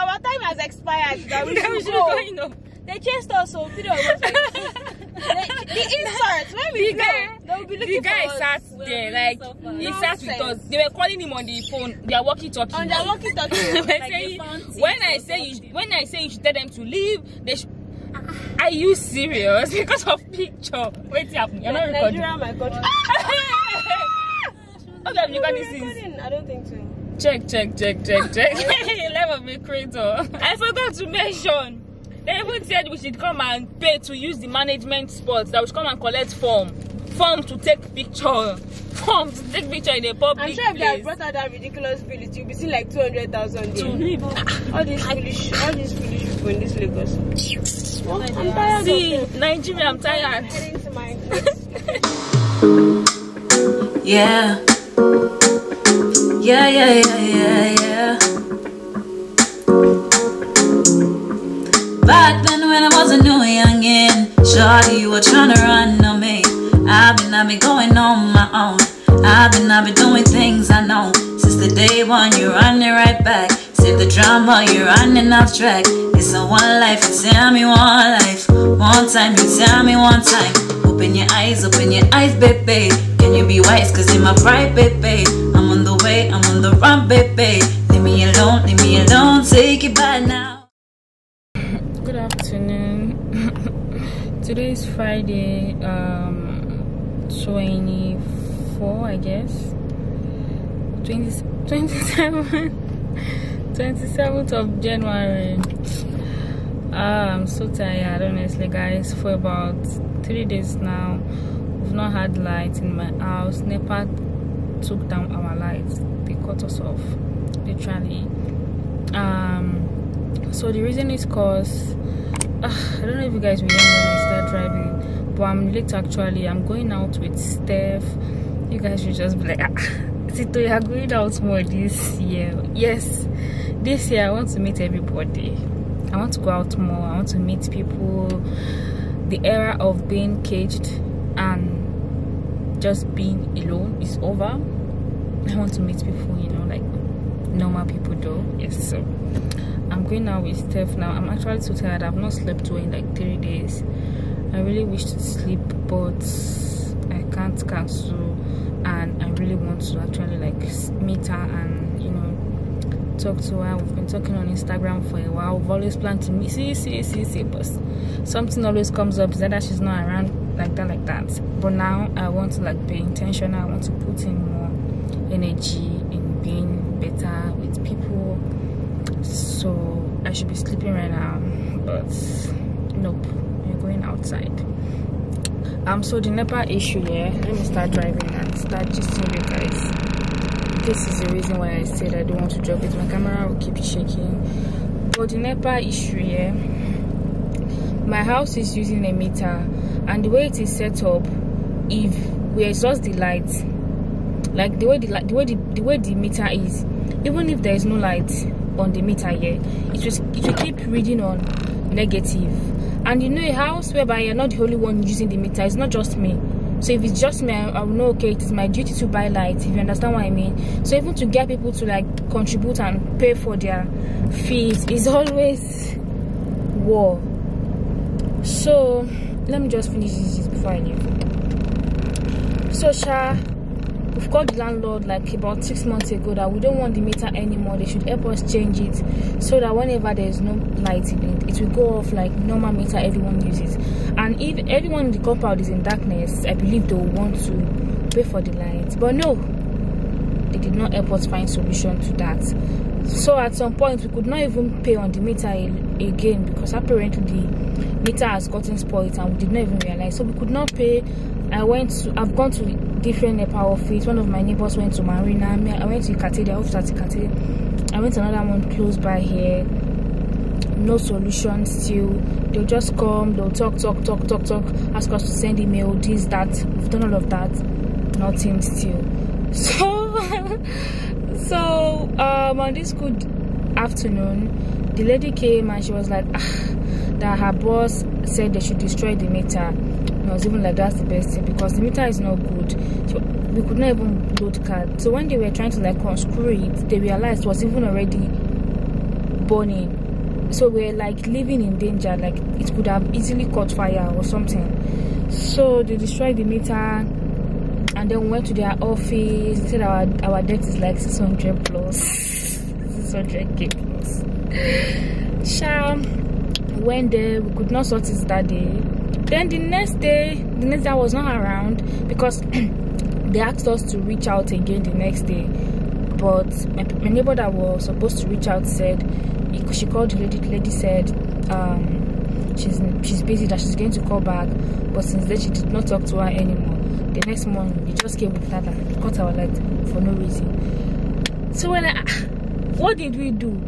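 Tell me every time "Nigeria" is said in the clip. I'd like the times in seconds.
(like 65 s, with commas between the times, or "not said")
22 s, 49 s.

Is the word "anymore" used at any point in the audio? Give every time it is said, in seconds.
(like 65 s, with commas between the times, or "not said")
237 s, 336 s.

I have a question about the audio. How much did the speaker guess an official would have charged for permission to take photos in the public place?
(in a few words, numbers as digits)
200,000.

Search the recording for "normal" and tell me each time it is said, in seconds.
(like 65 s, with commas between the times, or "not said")
147 s, 242 s.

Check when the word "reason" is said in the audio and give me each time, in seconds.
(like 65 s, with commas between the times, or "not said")
120 s, 191 s, 340 s.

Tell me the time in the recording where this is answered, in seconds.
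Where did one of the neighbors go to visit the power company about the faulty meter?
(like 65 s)
265 s.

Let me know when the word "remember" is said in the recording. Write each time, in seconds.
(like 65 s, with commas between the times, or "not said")
123 s.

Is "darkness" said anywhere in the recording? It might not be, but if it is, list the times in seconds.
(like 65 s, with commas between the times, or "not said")
245 s.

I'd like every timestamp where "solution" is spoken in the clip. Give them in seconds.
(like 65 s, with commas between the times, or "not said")
251 s, 270 s.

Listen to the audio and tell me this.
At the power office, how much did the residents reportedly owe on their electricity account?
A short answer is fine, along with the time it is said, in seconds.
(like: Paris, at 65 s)
600k, at 313 s.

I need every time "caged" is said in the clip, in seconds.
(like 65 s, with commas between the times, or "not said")
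140 s.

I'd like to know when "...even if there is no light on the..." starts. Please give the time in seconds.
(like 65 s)
207 s.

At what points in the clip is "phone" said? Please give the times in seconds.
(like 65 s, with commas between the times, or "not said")
11 s.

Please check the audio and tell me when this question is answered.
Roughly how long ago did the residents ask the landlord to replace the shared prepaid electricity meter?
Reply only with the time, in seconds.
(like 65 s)
235 s.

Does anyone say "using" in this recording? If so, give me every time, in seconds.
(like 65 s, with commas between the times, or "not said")
198 s, 215 s.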